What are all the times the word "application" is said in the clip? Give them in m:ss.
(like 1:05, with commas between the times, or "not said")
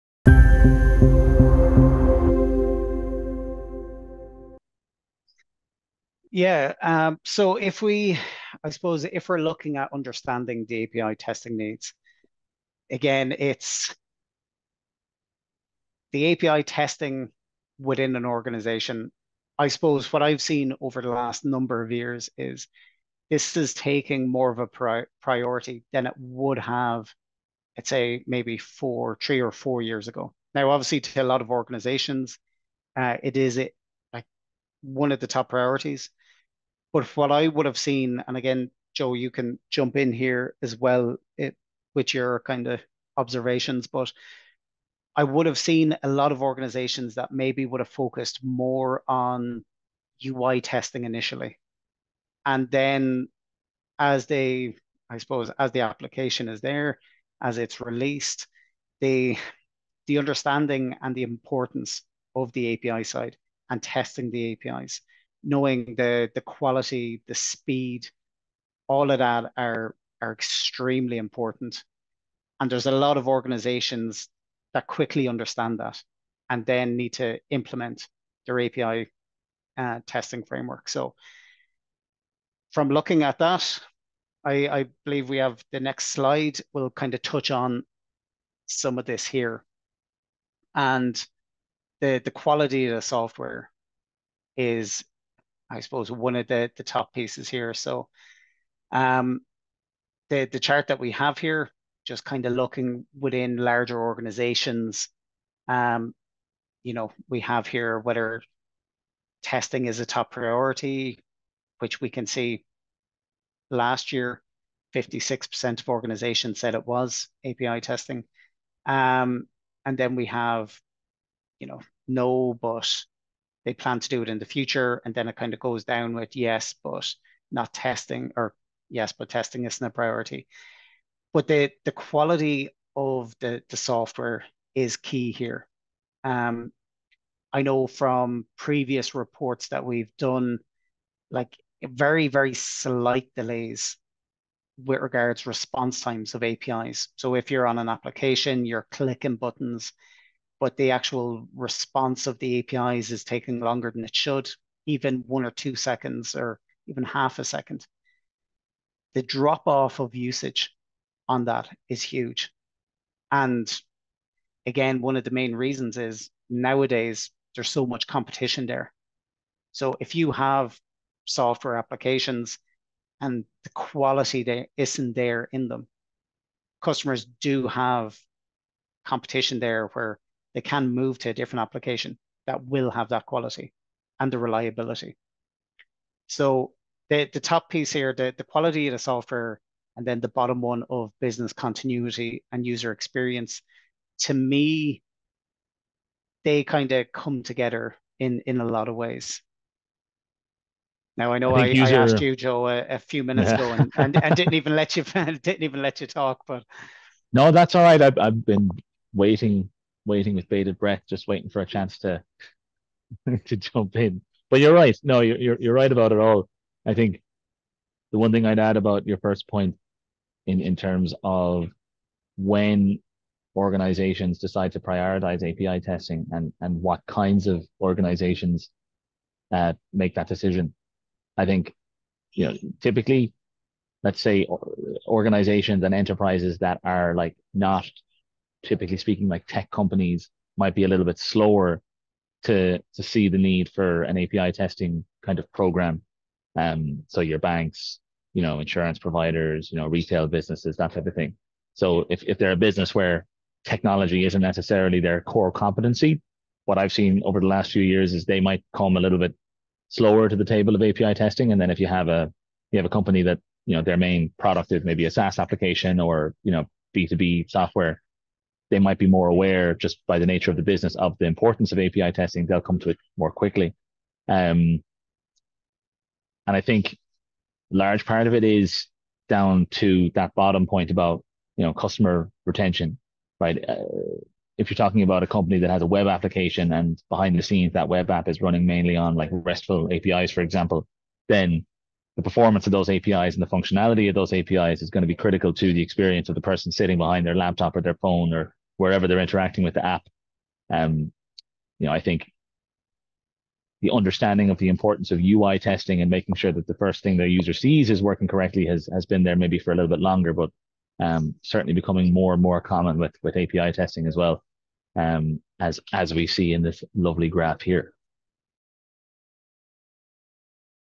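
0:55, 2:27, 2:51, 3:01, 4:25, 4:46.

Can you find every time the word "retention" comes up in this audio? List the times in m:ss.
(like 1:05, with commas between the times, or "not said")
4:42.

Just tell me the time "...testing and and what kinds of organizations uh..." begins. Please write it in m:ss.
3:45.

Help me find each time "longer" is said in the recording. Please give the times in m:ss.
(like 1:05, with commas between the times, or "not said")
2:33, 5:09.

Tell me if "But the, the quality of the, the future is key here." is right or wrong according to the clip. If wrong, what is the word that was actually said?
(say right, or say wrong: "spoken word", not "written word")
wrong: "software", not "future".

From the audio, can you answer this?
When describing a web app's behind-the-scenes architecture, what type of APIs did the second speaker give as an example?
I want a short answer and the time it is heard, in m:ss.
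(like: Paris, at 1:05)
RESTful APIs, at 4:49.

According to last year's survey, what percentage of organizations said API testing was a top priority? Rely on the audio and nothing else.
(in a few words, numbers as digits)
56%.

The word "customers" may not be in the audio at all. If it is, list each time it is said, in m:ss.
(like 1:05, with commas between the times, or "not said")
2:56, 4:41.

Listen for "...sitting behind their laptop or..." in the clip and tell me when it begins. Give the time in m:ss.
4:56.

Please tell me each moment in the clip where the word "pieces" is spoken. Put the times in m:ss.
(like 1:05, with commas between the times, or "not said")
1:37, 3:07.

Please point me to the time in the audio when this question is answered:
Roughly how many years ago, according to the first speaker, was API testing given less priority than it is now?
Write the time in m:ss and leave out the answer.
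0:29.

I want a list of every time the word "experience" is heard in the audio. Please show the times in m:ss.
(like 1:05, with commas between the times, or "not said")
3:12, 4:55.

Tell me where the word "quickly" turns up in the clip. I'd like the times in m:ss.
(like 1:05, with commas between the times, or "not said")
1:14, 4:33.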